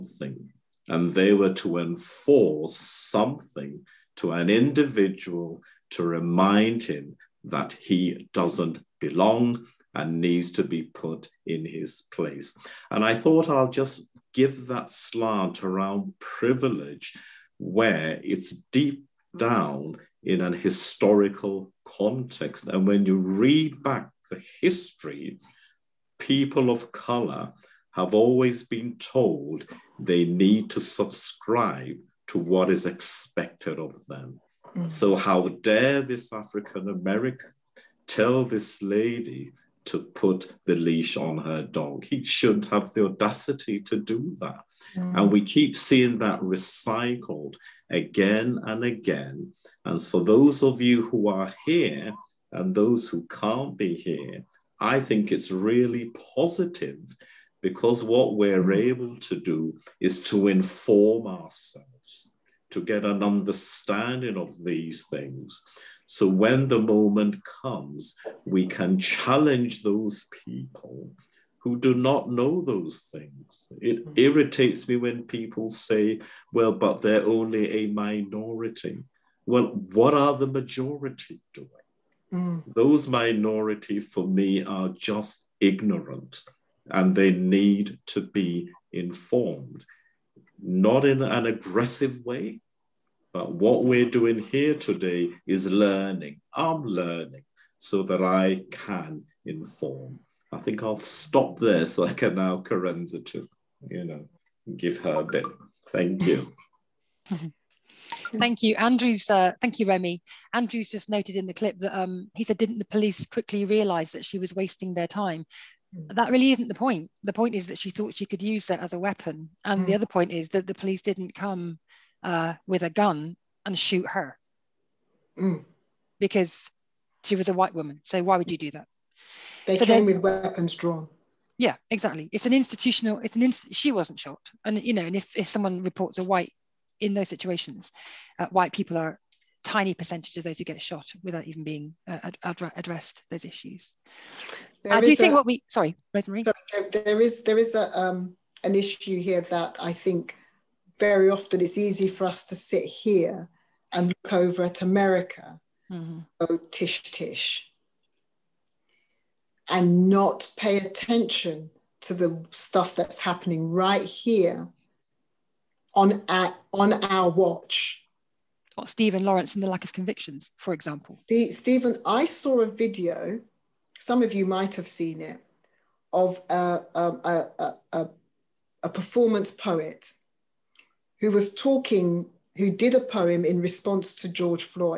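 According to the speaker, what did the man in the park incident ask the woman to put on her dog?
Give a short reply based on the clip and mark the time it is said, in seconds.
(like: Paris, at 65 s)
The leash, at 40 s.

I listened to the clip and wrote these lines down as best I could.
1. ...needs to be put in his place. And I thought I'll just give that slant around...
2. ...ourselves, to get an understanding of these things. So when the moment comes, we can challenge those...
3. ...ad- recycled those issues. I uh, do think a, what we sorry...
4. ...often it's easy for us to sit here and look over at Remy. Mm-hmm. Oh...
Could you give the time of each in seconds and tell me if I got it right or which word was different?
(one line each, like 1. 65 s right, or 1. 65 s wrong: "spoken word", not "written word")
1. 10 s right
2. 61 s right
3. 142 s wrong: "addressed", not "recycled"
4. 151 s wrong: "America", not "Remy".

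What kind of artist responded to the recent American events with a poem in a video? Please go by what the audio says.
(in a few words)
A performance poet.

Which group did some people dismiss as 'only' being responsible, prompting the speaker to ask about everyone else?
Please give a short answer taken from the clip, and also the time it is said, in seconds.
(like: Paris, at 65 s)
A minority, at 77 s.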